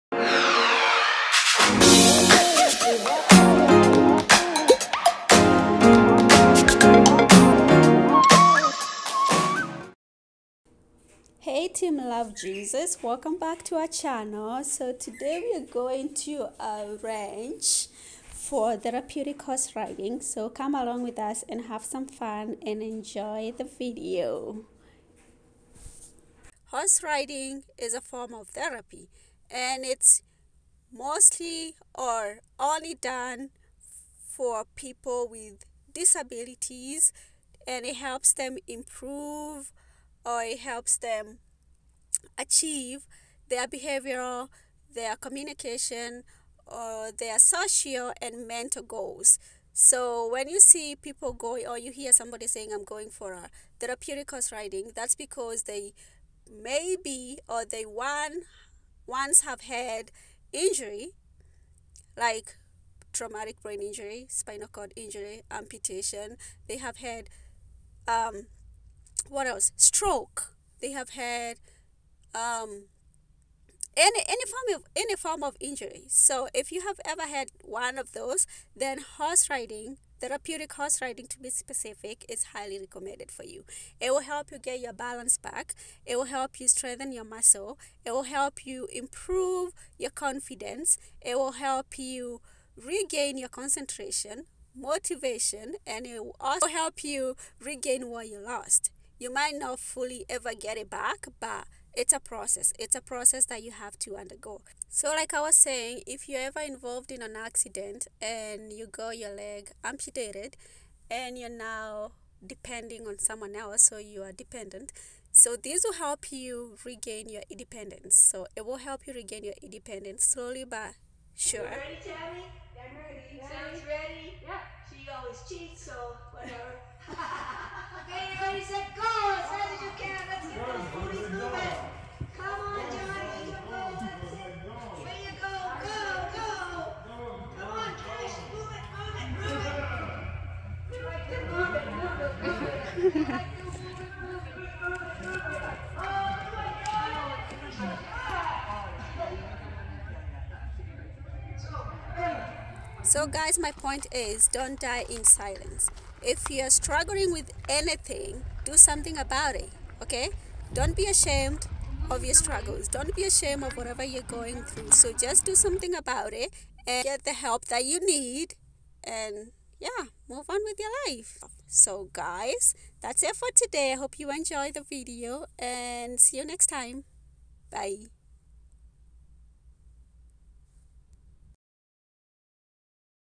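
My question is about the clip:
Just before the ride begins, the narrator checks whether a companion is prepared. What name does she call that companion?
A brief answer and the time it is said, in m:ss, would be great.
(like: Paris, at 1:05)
Tabby, at 2:02.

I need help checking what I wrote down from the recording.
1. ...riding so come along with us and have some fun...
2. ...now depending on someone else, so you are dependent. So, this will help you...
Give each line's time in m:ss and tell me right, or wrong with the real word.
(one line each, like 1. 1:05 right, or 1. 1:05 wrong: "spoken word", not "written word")
1. 0:19 right
2. 1:51 right.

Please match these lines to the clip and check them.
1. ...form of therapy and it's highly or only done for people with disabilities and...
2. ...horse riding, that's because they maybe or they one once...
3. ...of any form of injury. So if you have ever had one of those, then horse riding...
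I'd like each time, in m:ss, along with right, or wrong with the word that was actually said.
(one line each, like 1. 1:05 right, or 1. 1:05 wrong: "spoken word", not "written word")
1. 0:27 wrong: "mostly", not "highly"
2. 0:54 right
3. 1:14 right.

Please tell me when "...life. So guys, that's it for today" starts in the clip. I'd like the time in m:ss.
2:51.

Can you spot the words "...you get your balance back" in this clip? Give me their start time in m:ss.
1:24.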